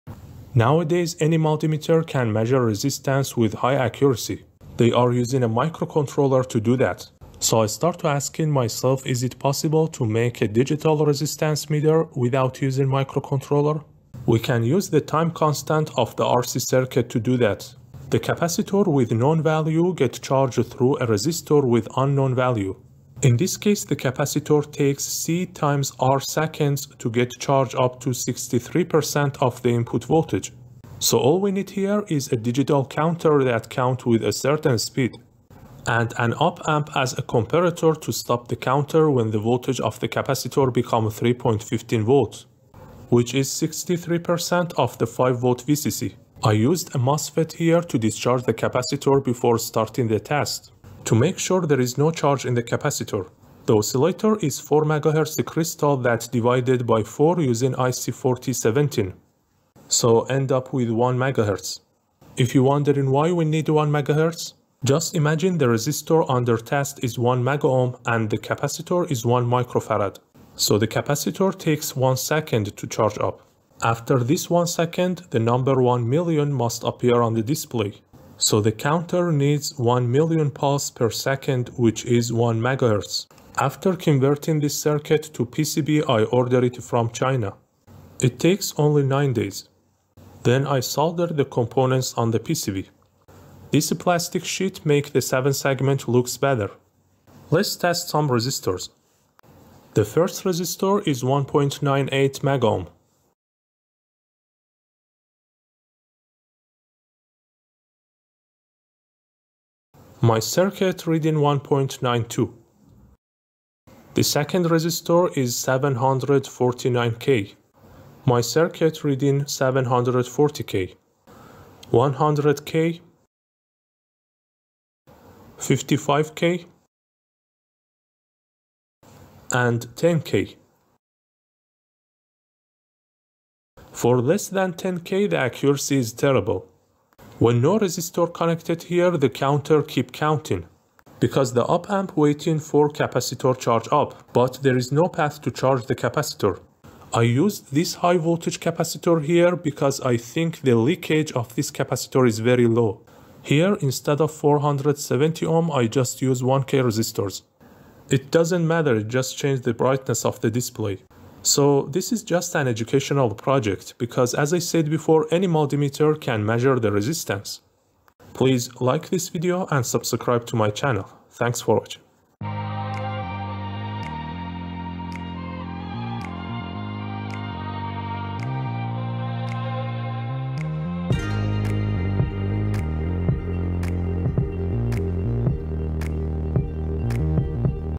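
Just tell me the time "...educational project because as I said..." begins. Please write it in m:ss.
2:42.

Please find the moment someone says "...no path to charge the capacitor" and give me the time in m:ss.
2:24.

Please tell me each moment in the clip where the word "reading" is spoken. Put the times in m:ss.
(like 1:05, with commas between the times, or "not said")
1:51, 1:59.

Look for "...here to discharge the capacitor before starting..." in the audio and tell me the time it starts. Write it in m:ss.
0:47.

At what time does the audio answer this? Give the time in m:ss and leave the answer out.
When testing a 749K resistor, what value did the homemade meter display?
1:59.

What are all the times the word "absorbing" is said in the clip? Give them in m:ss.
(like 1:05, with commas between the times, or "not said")
not said.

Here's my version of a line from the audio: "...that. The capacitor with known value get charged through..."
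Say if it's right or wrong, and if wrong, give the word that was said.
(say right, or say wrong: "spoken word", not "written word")
right.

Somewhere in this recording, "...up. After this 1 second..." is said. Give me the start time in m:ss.
1:13.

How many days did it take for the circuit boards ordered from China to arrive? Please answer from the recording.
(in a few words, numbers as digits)
9 days.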